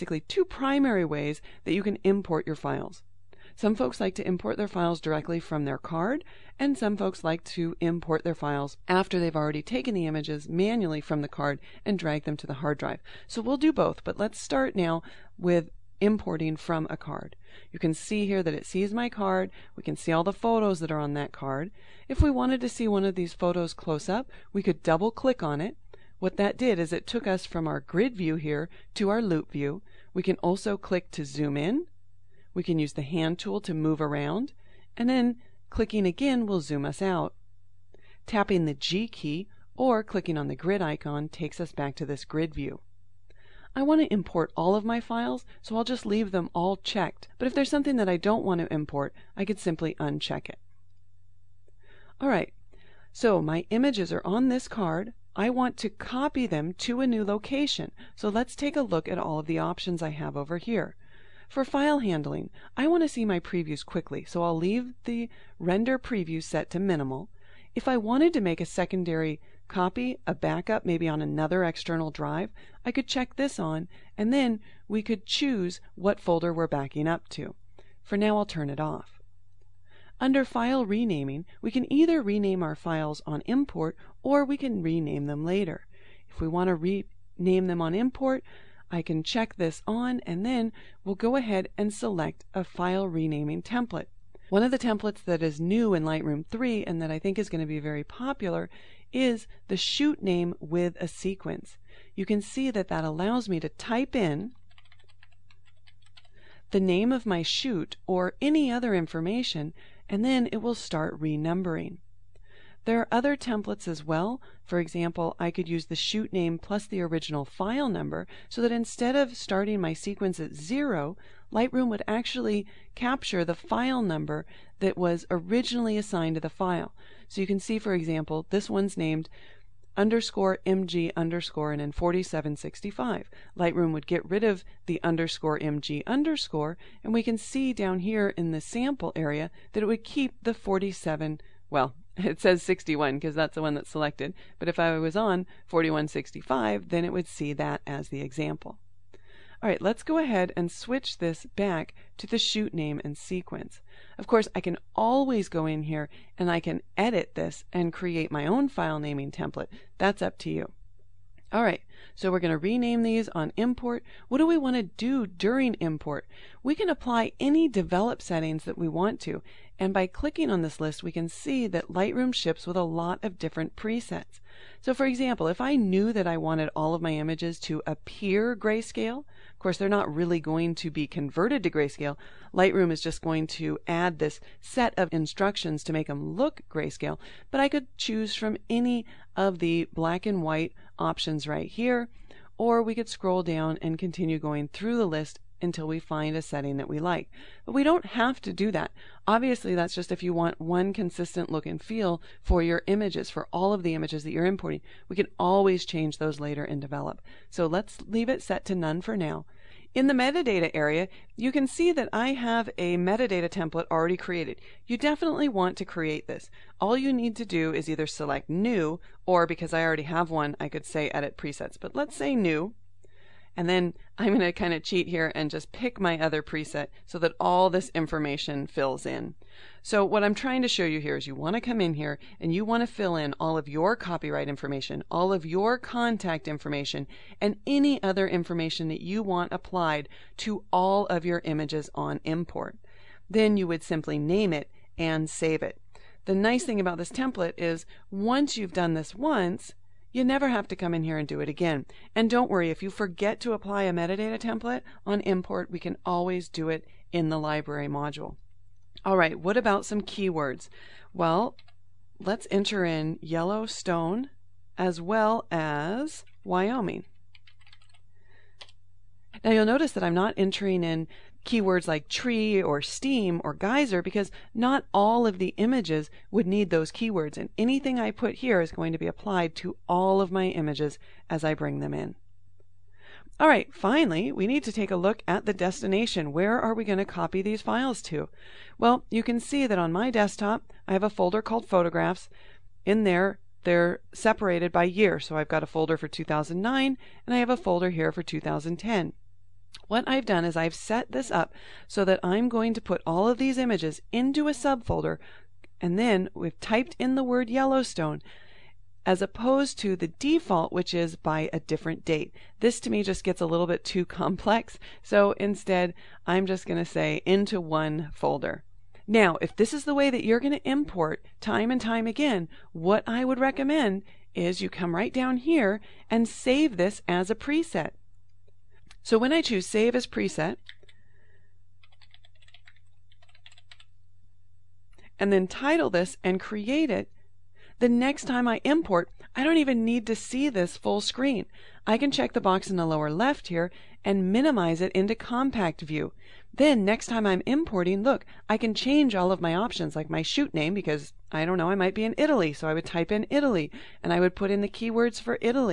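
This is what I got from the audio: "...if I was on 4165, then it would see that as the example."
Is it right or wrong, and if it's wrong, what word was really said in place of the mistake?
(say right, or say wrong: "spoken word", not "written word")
right.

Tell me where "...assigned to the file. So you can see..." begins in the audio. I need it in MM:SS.
02:05.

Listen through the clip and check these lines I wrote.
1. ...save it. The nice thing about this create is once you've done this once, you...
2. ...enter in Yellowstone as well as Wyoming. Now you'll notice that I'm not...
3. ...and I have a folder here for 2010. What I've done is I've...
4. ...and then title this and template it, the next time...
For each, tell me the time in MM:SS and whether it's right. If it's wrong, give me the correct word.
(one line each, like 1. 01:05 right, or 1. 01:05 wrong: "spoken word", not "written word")
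1. 04:05 wrong: "template", not "create"
2. 04:22 right
3. 04:57 right
4. 05:35 wrong: "create", not "template".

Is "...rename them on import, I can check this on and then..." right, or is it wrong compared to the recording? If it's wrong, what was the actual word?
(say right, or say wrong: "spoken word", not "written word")
right.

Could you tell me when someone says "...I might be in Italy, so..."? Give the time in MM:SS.
05:51.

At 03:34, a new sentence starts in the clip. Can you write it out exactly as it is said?
You definitely want to create this.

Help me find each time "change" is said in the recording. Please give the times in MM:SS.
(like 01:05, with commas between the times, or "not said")
03:25, 05:48.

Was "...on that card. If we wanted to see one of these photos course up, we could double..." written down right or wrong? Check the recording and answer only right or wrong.
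wrong.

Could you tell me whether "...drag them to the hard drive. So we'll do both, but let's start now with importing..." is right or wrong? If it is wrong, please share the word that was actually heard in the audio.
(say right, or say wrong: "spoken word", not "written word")
right.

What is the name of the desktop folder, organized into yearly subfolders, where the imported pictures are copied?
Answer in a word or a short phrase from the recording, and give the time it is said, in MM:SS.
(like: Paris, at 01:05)
Photographs, at 04:51.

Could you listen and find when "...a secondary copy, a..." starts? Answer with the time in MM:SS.
01:08.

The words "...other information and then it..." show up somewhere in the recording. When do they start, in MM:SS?
01:48.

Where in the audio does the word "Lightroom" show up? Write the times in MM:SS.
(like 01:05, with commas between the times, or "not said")
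01:36, 02:01, 02:13, 02:51, 03:02.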